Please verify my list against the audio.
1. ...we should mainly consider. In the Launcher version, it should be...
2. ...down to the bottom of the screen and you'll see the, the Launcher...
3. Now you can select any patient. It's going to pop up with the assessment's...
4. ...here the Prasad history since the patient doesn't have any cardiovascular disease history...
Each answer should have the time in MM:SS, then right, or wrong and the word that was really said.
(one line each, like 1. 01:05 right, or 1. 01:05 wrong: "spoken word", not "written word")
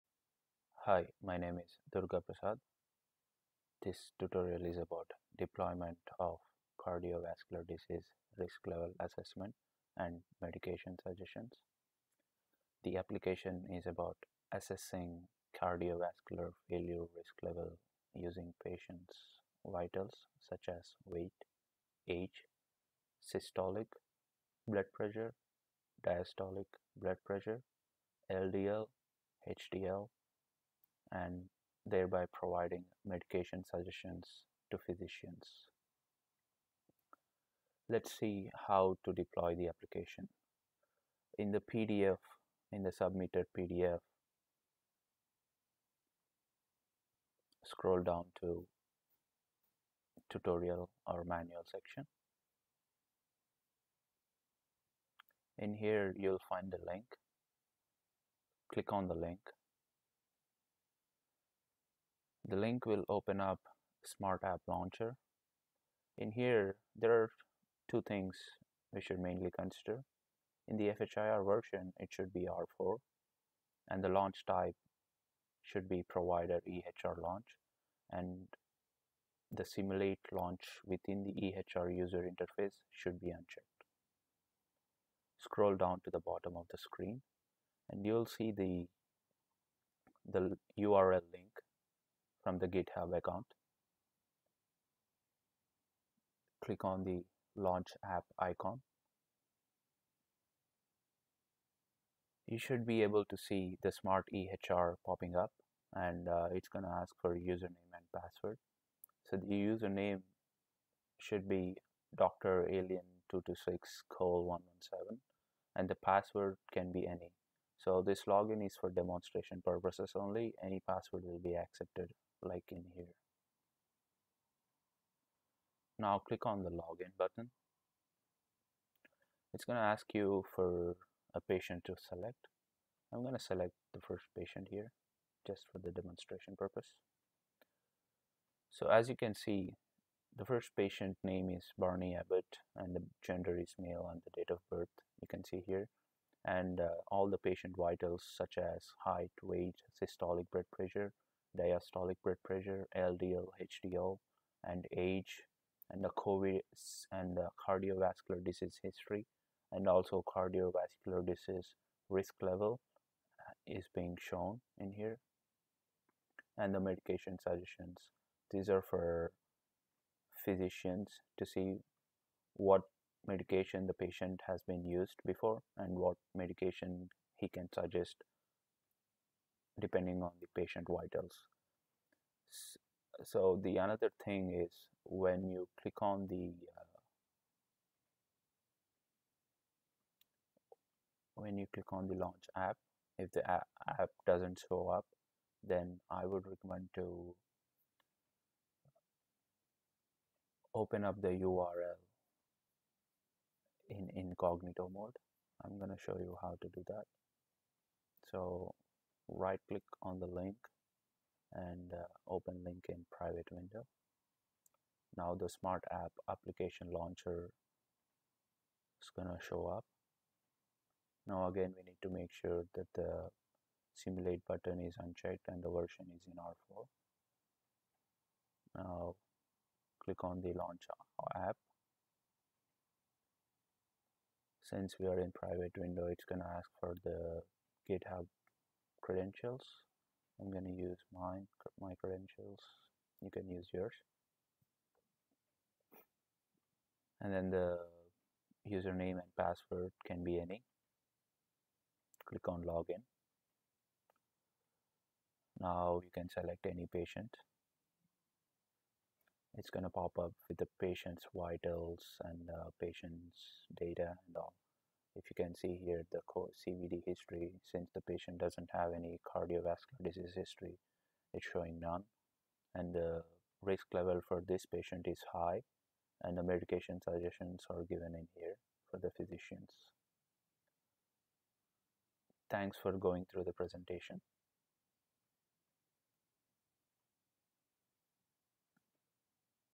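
1. 01:08 wrong: "FHIR", not "Launcher"
2. 01:25 wrong: "URL", not "Launcher"
3. 04:15 wrong: "patient", not "assessment"
4. 04:25 wrong: "CVD", not "Prasad".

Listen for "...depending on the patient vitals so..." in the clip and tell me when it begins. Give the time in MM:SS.
02:59.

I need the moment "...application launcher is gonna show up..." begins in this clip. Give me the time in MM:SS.
03:36.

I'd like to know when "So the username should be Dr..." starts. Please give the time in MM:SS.
01:49.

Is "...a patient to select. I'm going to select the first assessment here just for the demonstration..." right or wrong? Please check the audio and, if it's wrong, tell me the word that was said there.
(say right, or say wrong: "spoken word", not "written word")
wrong: "patient", not "assessment".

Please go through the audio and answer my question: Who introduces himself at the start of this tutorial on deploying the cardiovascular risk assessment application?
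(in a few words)
Durga Prasad.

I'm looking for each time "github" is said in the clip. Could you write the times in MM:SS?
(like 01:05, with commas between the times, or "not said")
01:32, 03:57.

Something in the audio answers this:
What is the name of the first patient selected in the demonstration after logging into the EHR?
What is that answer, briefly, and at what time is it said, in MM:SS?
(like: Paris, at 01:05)
Barney Abbott, at 02:21.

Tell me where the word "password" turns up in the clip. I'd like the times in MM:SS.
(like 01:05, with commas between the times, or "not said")
01:48, 01:55, 02:00, 04:09.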